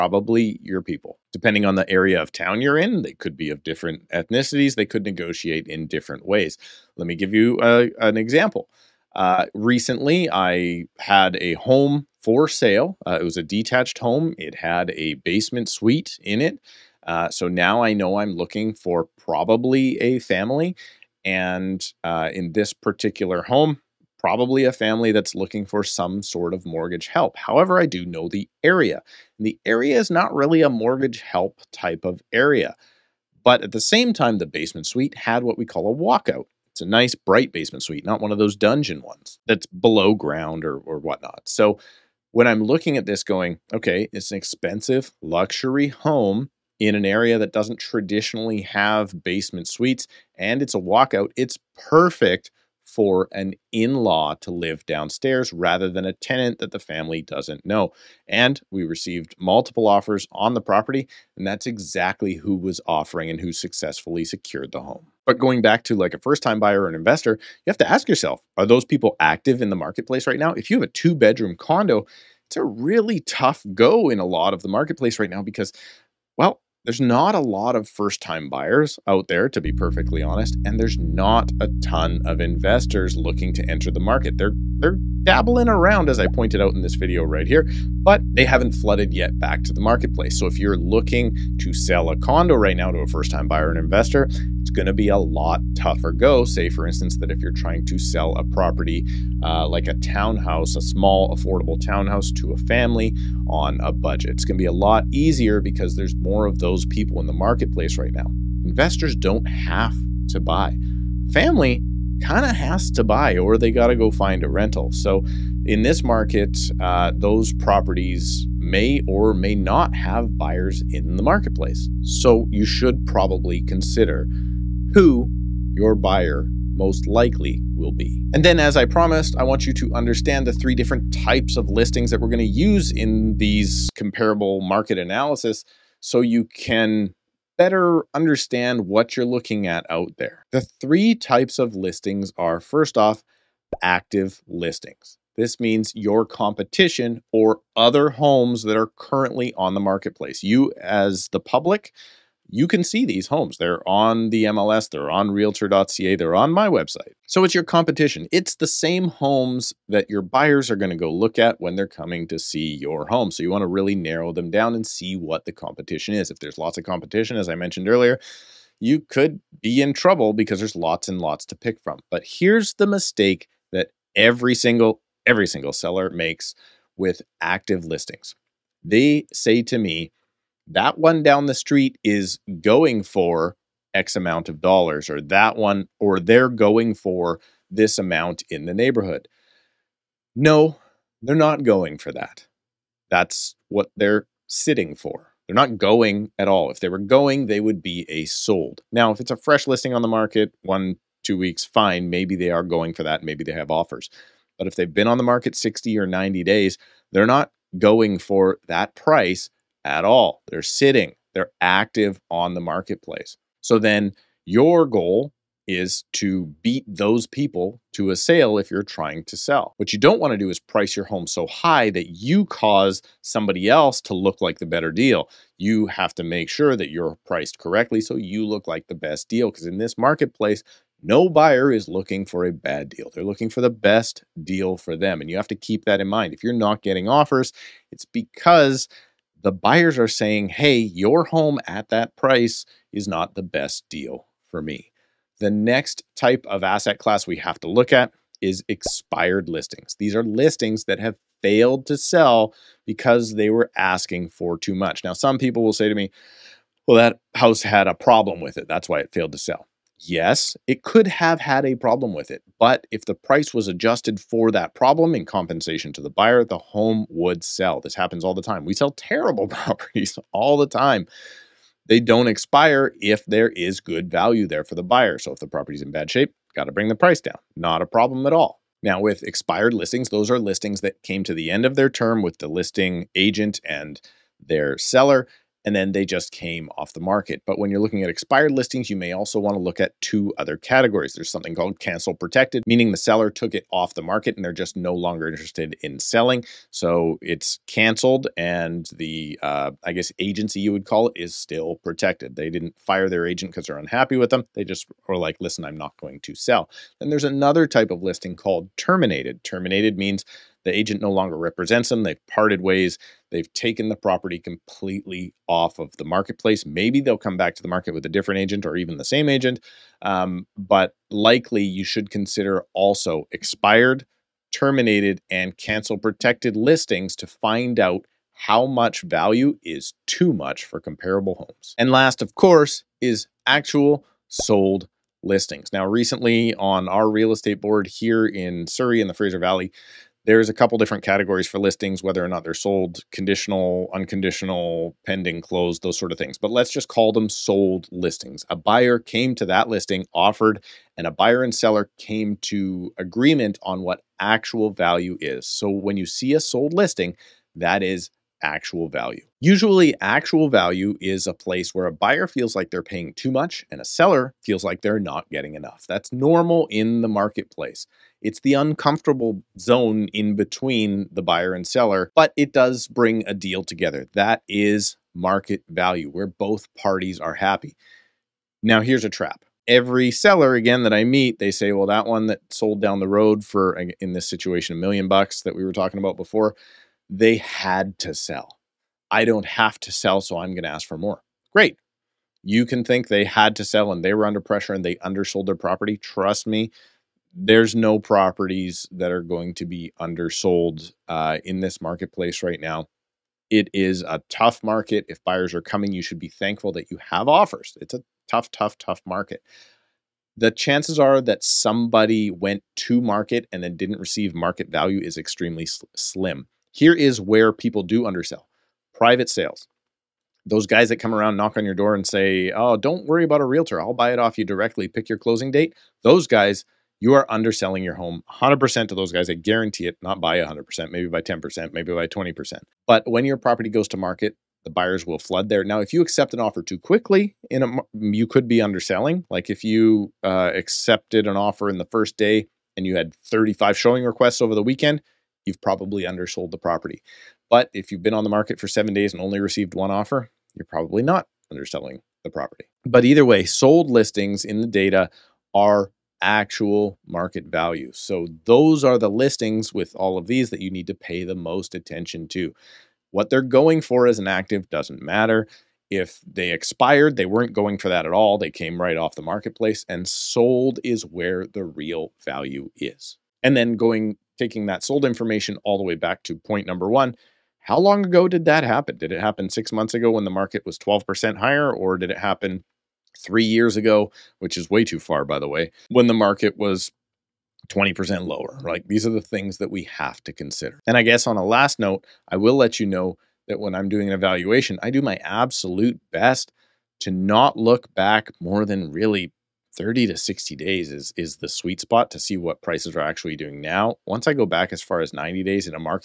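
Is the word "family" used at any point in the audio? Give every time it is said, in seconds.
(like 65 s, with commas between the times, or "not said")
20 s, 24 s, 56 s, 102 s, 111 s.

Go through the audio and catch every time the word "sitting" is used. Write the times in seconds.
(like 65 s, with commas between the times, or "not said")
194 s, 210 s.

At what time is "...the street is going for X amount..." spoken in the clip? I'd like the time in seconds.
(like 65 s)
181 s.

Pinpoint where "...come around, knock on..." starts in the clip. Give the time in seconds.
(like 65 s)
420 s.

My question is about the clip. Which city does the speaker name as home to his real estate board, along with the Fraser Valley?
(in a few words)
Surrey.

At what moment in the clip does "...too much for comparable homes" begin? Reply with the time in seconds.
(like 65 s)
330 s.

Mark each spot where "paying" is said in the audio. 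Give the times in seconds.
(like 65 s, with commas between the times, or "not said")
362 s.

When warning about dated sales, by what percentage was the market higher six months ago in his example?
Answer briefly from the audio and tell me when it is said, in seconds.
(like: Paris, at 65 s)
12%, at 480 s.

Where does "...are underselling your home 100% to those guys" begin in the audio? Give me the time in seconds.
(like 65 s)
427 s.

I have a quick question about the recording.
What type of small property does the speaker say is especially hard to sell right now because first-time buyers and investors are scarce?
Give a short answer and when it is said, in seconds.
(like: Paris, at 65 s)
two bedroom condo, at 70 s.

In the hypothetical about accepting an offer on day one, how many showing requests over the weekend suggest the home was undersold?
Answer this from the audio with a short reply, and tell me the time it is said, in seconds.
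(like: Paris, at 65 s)
35, at 443 s.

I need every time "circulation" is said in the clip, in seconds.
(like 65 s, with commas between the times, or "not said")
not said.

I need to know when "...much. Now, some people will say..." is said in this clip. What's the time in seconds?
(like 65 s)
254 s.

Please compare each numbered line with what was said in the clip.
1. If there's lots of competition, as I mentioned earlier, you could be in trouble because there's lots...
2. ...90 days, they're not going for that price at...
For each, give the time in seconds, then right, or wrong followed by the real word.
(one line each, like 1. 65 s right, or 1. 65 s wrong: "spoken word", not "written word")
1. 166 s right
2. 206 s right.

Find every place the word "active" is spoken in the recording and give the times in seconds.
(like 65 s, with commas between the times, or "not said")
69 s, 143 s, 177 s, 211 s, 464 s.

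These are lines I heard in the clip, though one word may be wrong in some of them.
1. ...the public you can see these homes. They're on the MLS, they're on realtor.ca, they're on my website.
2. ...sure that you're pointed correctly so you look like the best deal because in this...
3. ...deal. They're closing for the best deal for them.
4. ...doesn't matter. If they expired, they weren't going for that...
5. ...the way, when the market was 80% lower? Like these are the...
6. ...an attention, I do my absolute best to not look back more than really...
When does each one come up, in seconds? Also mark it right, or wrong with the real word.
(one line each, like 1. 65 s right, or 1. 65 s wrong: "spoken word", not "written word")
1. 151 s right
2. 226 s wrong: "priced", not "pointed"
3. 232 s wrong: "looking", not "closing"
4. 464 s right
5. 485 s wrong: "20", not "80"
6. 494 s wrong: "evaluation", not "attention".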